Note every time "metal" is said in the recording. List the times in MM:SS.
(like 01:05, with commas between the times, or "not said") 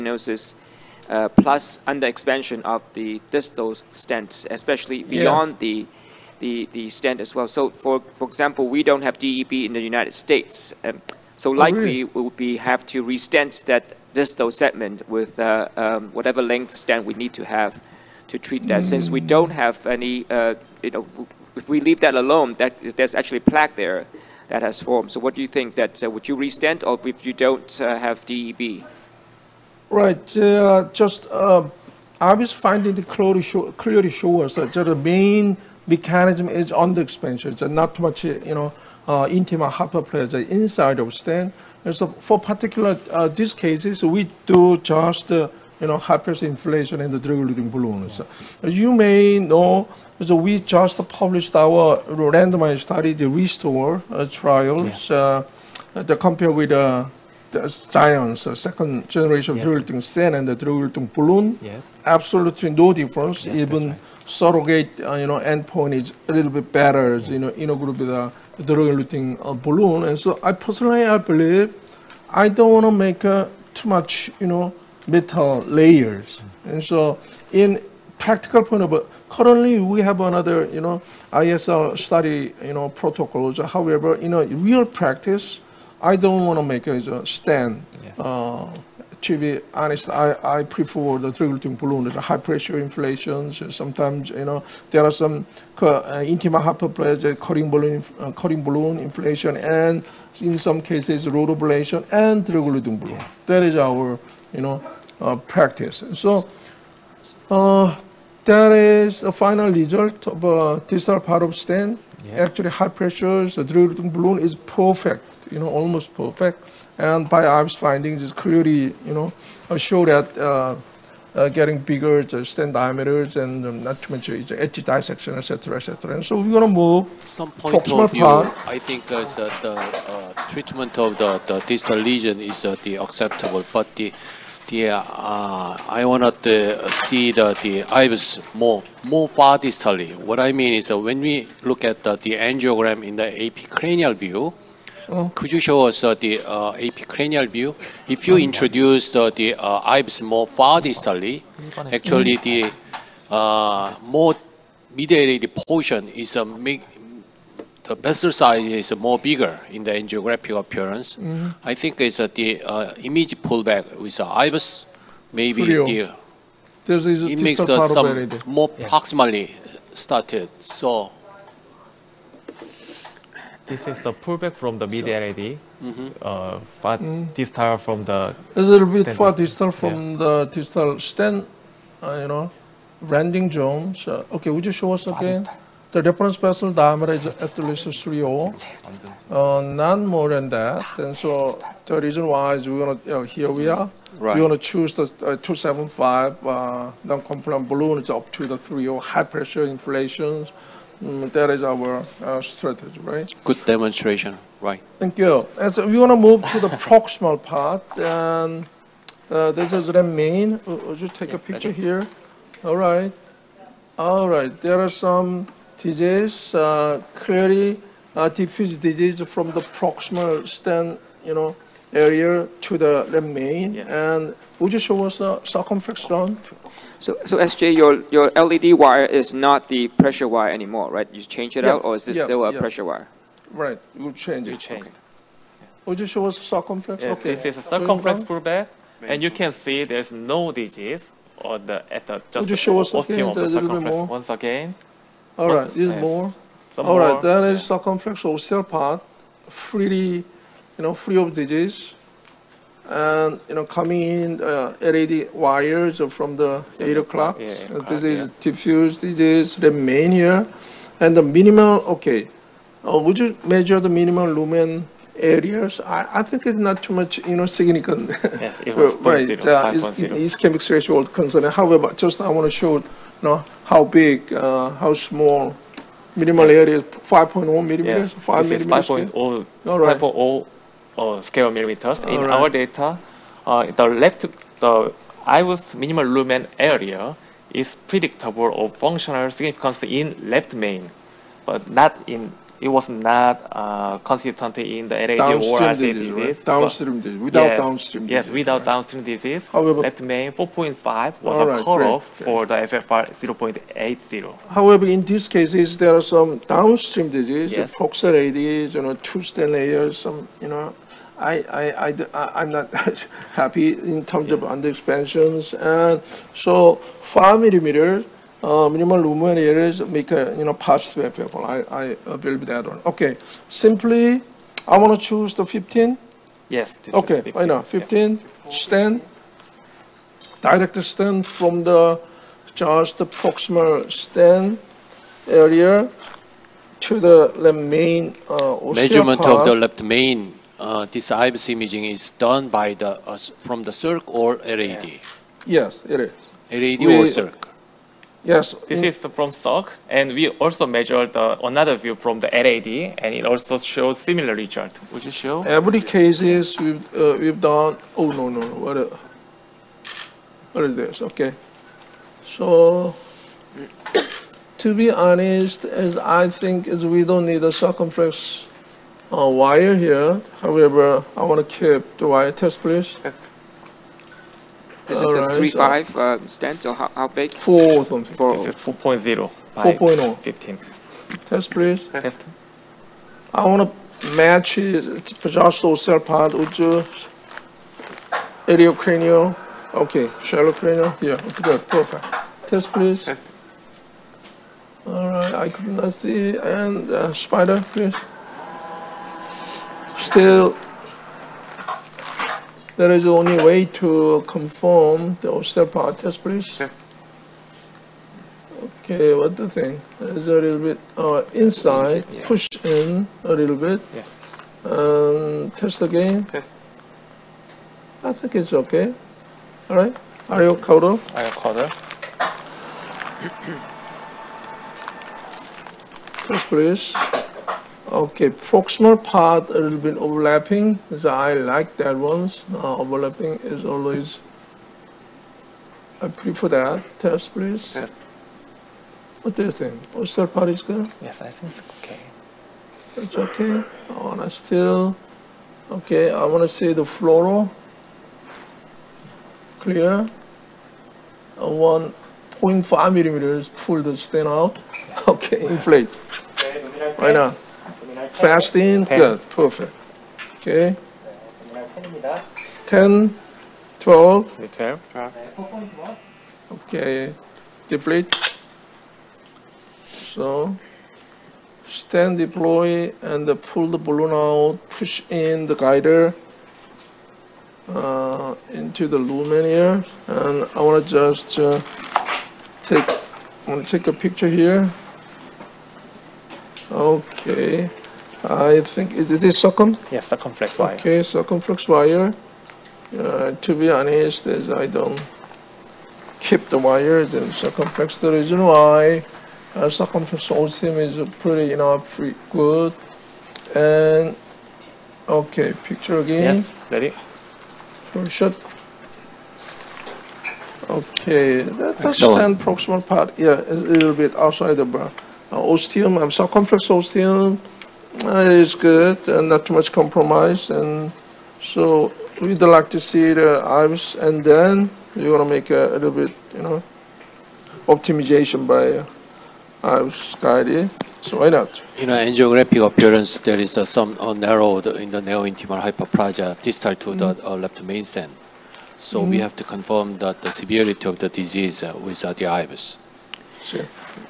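01:15.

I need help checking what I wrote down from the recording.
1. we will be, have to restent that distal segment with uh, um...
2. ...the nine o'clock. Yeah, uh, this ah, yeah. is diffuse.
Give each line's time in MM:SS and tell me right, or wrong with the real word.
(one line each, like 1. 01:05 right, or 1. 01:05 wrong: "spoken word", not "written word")
1. 00:12 right
2. 04:16 wrong: "eight", not "nine".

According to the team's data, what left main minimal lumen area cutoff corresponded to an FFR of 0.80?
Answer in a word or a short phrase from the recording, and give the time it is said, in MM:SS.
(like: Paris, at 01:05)
4.5, at 05:00.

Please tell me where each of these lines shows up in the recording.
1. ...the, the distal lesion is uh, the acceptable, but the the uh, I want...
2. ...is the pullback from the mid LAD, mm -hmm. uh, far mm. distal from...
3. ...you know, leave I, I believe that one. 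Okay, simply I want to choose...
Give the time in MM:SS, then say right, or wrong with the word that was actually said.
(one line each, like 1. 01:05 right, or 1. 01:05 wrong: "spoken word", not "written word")
1. 02:11 right
2. 02:53 right
3. 05:20 wrong: "positive", not "leave".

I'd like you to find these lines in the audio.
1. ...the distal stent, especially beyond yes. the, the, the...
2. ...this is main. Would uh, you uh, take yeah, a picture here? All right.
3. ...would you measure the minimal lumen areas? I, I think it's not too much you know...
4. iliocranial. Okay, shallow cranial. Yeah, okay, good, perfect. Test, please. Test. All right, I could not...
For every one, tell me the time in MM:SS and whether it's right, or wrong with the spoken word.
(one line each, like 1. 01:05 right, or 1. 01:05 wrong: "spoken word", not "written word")
1. 00:02 right
2. 03:29 right
3. 04:22 right
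4. 06:28 right.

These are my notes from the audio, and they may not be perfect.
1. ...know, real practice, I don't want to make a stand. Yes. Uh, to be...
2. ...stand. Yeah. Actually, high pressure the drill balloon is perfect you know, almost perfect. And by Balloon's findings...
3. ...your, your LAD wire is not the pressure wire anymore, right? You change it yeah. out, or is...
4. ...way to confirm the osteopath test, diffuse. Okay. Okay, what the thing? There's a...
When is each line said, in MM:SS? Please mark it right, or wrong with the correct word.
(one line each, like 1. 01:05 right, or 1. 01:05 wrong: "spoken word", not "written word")
1. 01:24 right
2. 01:51 wrong: "PyArb", not "Balloon"
3. 03:47 right
4. 06:43 wrong: "please", not "diffuse".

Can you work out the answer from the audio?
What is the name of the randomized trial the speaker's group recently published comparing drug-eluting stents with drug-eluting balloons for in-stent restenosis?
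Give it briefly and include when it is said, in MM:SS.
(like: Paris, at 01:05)
RESTORE, at 00:53.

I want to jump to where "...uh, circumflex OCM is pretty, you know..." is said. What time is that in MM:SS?
08:19.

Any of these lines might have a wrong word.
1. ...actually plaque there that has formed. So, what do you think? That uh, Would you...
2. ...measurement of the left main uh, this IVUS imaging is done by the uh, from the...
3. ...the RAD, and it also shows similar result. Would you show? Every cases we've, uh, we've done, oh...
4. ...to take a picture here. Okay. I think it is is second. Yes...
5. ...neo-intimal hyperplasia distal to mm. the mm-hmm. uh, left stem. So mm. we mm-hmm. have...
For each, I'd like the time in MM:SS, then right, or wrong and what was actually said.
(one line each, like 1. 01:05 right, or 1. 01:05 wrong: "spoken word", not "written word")
1. 00:23 right
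2. 05:38 right
3. 05:52 right
4. 08:03 right
5. 08:55 right.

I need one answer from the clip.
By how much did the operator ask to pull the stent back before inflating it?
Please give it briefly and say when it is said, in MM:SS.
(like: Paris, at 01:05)
1.5 mm, at 07:31.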